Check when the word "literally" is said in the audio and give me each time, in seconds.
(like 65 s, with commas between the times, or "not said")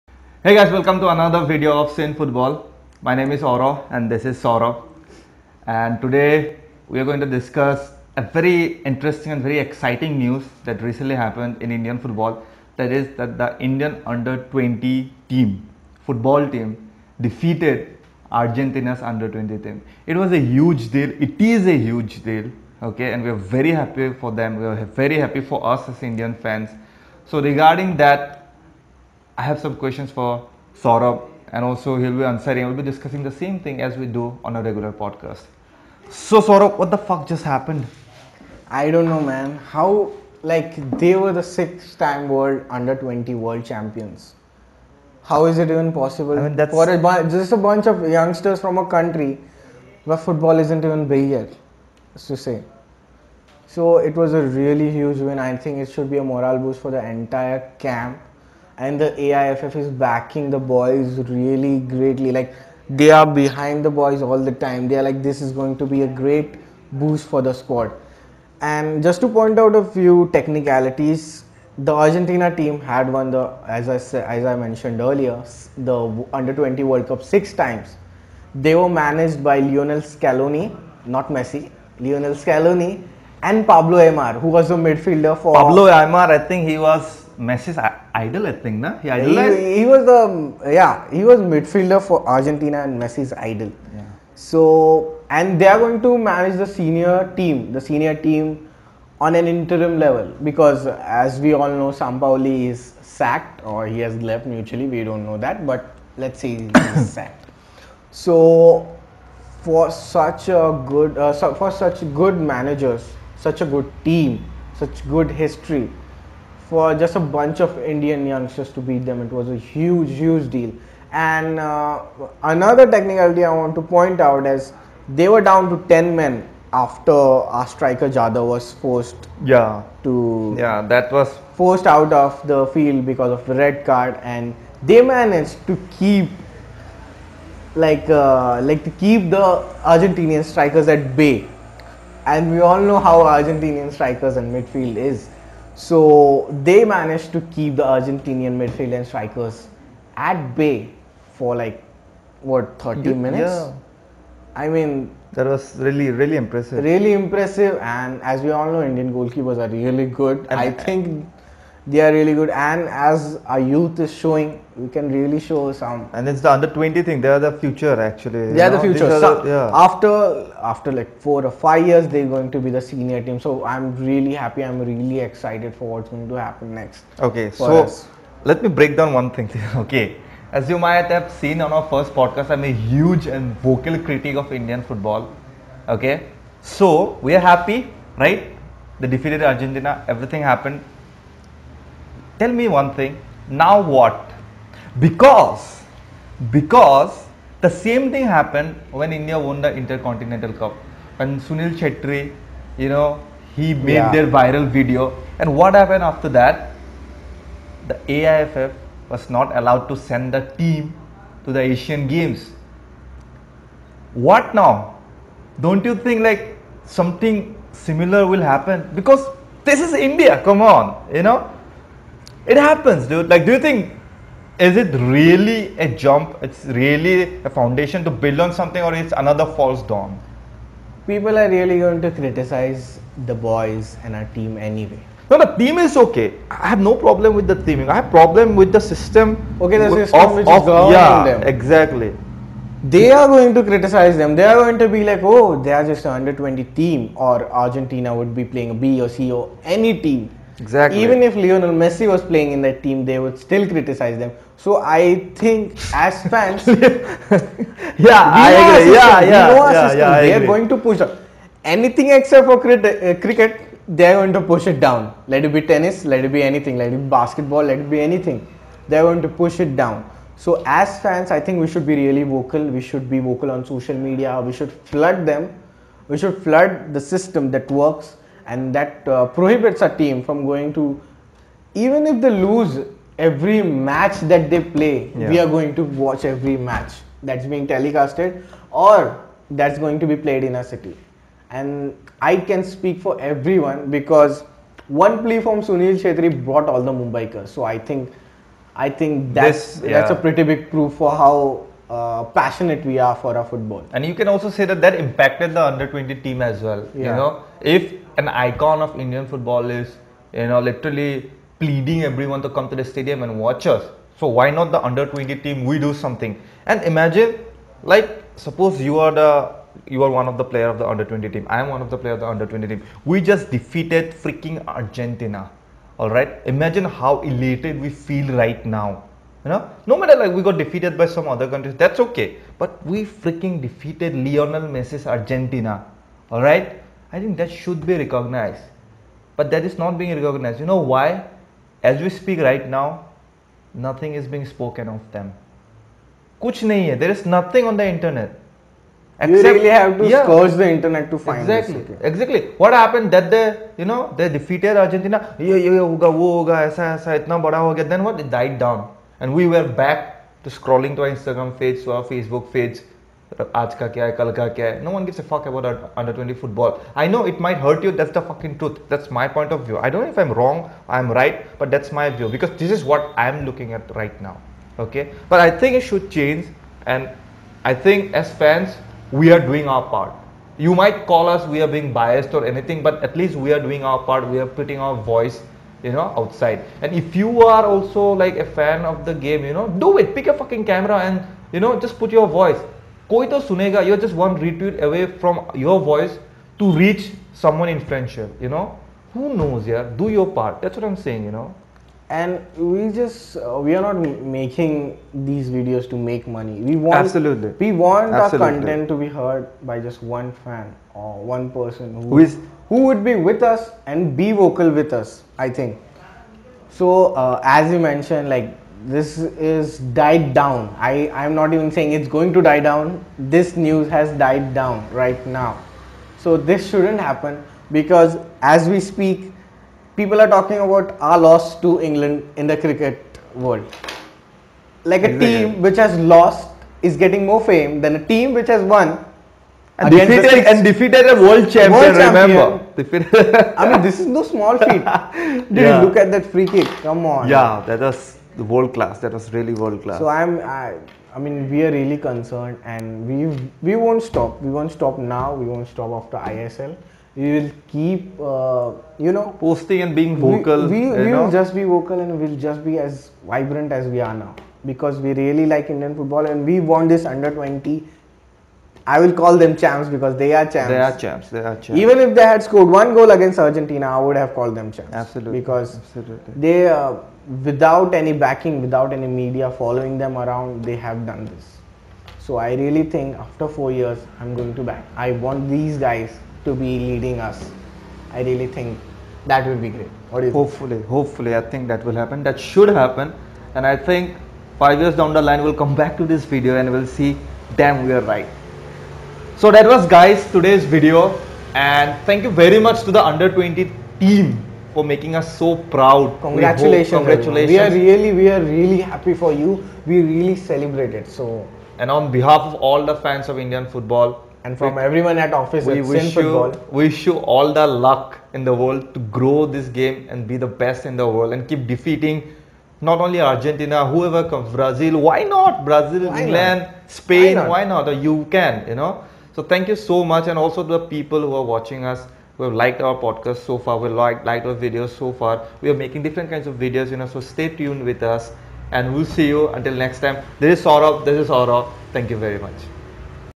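310 s.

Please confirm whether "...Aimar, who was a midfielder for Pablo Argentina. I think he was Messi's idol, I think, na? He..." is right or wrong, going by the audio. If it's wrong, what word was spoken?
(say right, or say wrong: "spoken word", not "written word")
wrong: "Aimar", not "Argentina".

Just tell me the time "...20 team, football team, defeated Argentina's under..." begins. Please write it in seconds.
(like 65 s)
14 s.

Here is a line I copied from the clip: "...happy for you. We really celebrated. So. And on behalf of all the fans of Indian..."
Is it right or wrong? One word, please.
right.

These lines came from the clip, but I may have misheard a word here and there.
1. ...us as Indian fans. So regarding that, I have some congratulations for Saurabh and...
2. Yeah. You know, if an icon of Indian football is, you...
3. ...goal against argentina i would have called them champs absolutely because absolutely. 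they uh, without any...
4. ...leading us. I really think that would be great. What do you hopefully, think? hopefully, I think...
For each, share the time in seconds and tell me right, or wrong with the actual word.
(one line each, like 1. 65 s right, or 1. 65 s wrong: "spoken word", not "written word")
1. 25 s wrong: "questions", not "congratulations"
2. 306 s right
3. 472 s right
4. 486 s right.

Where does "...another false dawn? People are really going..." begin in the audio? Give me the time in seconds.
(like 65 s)
229 s.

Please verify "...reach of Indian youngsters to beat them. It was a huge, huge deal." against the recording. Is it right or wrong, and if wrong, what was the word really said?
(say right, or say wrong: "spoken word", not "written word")
wrong: "bunch", not "reach".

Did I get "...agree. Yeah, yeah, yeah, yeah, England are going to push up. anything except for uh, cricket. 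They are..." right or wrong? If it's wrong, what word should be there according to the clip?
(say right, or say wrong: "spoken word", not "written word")
wrong: "They", not "England".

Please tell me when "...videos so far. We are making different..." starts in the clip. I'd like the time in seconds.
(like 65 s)
534 s.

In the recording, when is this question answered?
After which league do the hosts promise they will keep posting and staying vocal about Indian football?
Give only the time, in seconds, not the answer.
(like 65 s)
456 s.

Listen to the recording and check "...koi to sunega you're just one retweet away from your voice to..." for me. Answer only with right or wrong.
right.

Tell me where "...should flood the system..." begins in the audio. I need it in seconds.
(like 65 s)
276 s.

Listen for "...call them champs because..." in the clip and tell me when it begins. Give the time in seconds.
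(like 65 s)
469 s.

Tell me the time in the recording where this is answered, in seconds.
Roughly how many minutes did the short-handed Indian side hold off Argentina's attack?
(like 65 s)
152 s.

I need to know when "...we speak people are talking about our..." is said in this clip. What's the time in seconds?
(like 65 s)
428 s.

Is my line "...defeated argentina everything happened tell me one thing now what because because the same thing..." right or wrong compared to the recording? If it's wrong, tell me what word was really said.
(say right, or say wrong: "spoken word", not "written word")
right.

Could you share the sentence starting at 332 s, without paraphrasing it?
But we freaking defeated Lionel Messi's Argentina.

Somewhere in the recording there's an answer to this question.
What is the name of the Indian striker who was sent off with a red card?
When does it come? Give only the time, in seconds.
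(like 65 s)
128 s.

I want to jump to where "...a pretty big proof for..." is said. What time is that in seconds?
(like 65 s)
300 s.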